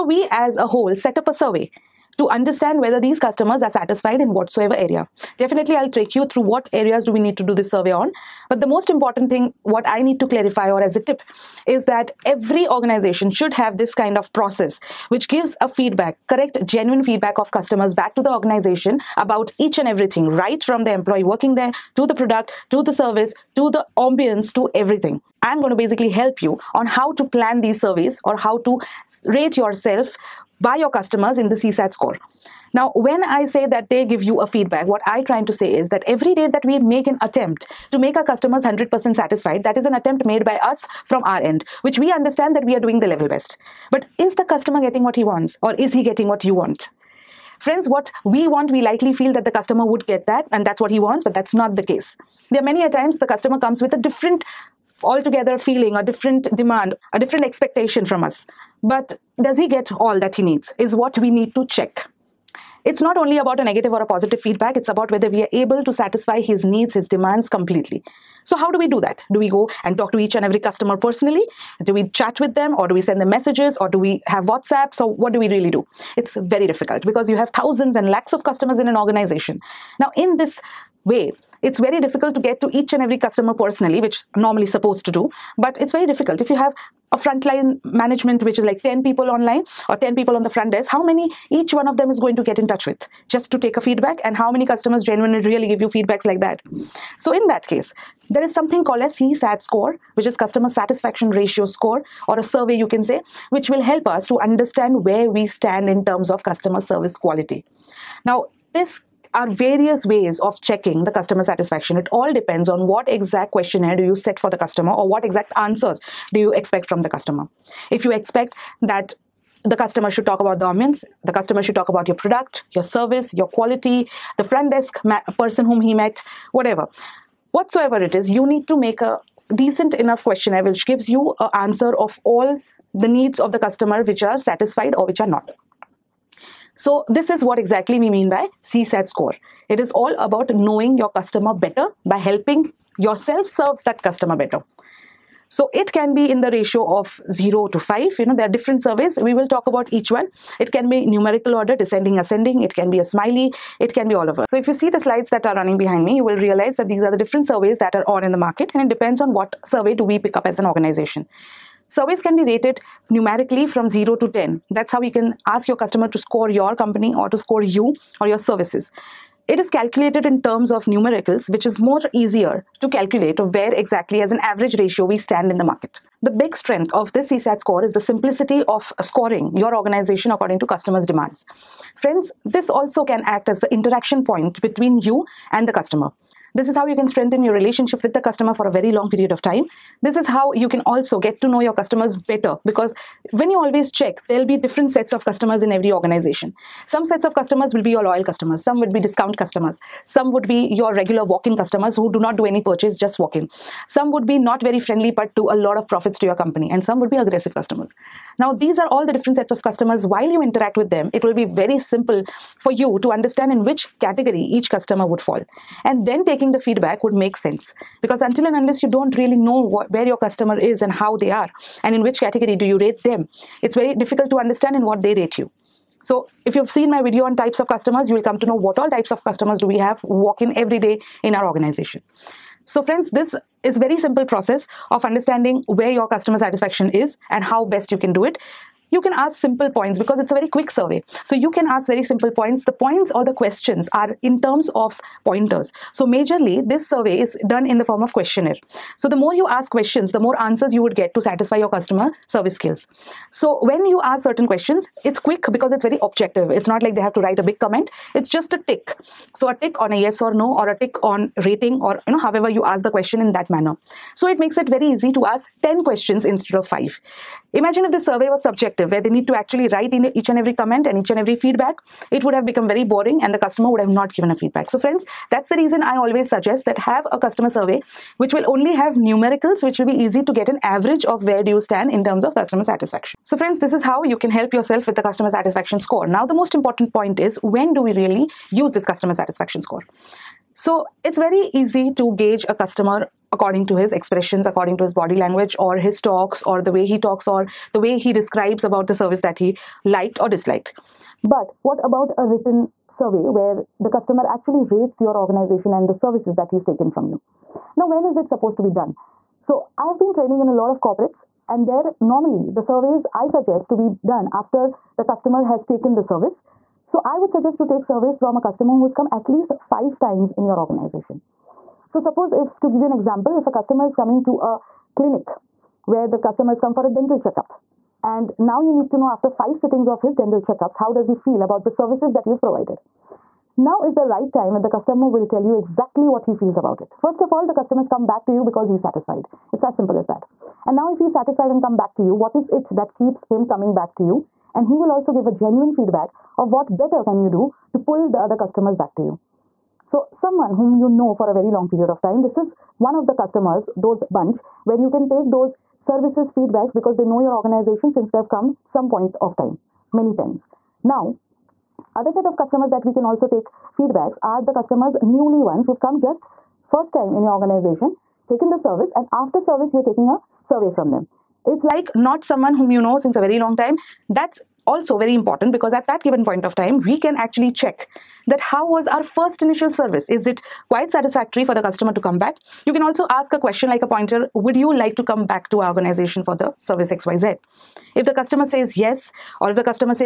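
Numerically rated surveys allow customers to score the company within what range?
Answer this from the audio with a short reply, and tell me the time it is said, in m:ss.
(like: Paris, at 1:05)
0 to 10, at 2:43.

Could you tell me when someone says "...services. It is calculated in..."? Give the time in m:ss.
2:48.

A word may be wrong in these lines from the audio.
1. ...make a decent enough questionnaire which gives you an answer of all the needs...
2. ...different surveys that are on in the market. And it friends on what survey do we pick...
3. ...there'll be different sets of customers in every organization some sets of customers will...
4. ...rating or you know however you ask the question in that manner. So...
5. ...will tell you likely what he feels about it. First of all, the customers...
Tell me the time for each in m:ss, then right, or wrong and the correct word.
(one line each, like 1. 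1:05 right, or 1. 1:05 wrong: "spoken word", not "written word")
1. 2:08 right
2. 2:37 wrong: "depends", not "friends"
3. 3:14 right
4. 4:21 right
5. 5:35 wrong: "exactly", not "likely".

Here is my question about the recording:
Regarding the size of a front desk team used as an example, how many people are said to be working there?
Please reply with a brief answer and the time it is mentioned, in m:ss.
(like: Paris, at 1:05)
10, at 1:29.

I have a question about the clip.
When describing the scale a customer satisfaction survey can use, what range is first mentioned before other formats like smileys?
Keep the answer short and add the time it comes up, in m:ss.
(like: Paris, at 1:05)
0 to 5, at 2:27.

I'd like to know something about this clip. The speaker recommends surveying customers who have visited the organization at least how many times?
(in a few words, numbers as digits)
5 times.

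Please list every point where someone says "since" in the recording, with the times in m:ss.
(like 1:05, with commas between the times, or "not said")
5:57, 6:12.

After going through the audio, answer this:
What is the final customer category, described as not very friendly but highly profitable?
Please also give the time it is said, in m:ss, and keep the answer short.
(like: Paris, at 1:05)
aggressive customers, at 3:27.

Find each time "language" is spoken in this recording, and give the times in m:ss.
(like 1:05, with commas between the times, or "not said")
4:55.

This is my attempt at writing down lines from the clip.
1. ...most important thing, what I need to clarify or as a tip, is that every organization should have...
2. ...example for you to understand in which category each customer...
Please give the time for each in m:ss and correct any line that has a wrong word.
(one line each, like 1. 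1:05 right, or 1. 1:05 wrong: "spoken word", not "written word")
1. 0:08 right
2. 3:31 wrong: "simple", not "example".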